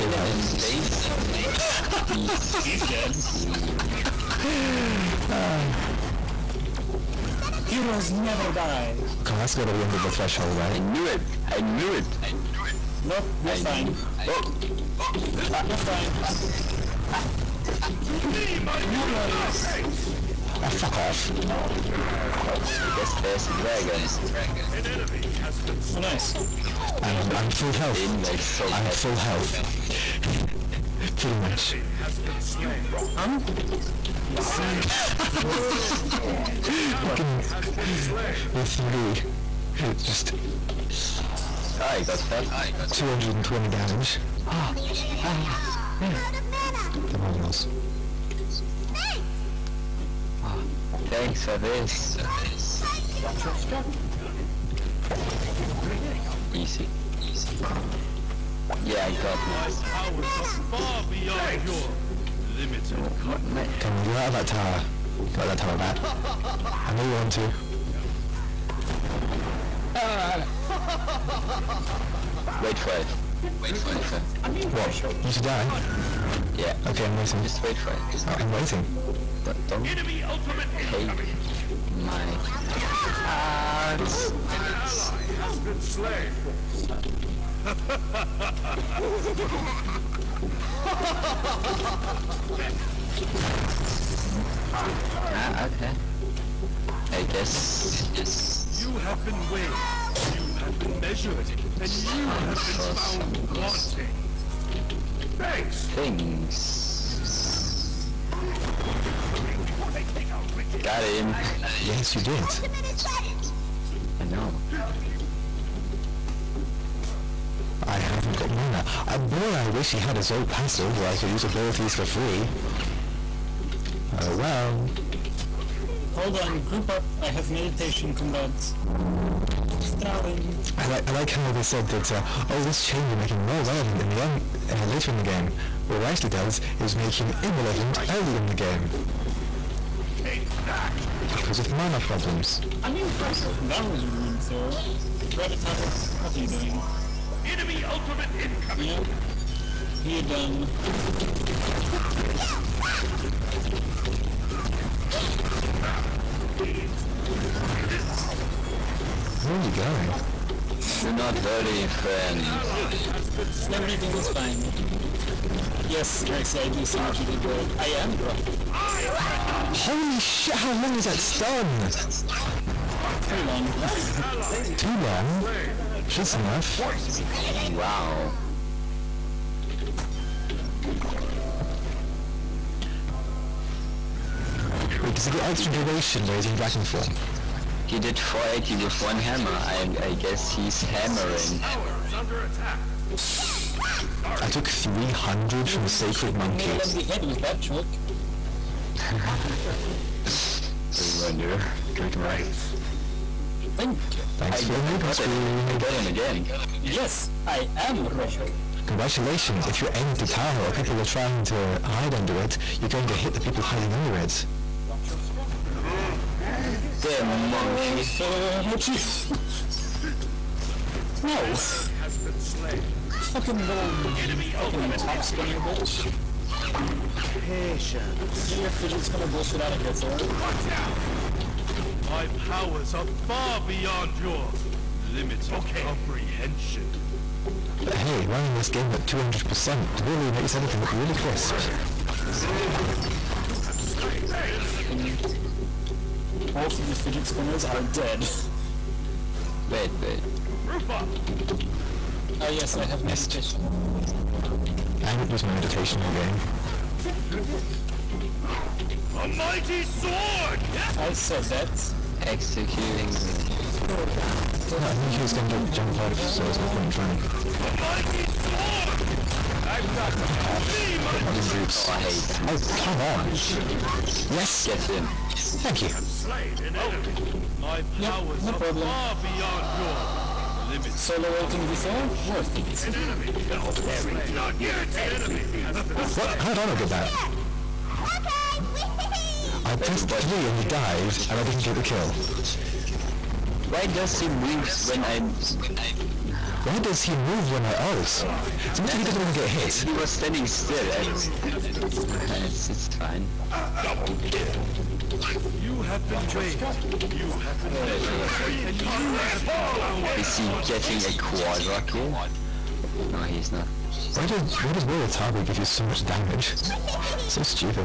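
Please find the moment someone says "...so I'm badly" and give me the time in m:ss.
0:28.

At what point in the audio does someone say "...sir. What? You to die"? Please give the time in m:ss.
1:14.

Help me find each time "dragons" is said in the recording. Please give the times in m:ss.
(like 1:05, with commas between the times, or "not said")
0:23, 3:06.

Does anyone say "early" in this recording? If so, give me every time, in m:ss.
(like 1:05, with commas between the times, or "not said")
2:18.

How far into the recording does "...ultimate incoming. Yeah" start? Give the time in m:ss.
2:27.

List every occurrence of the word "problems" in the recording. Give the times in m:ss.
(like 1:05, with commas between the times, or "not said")
2:22, 4:38.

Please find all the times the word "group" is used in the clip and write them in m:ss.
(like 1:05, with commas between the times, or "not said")
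2:06.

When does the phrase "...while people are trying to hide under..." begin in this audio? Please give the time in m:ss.
3:30.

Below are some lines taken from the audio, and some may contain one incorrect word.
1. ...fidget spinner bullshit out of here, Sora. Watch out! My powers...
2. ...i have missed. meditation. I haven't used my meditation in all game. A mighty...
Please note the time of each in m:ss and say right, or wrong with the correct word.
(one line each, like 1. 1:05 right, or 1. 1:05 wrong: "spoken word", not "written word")
1. 3:48 wrong: "Thor", not "Sora"
2. 4:12 right.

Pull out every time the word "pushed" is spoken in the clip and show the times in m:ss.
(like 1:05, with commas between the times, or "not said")
not said.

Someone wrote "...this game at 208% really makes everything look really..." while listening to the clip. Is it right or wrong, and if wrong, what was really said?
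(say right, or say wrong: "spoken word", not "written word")
wrong: "200", not "208".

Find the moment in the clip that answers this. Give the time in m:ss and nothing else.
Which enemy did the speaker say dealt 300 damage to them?
3:15.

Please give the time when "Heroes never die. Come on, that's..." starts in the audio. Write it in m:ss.
0:07.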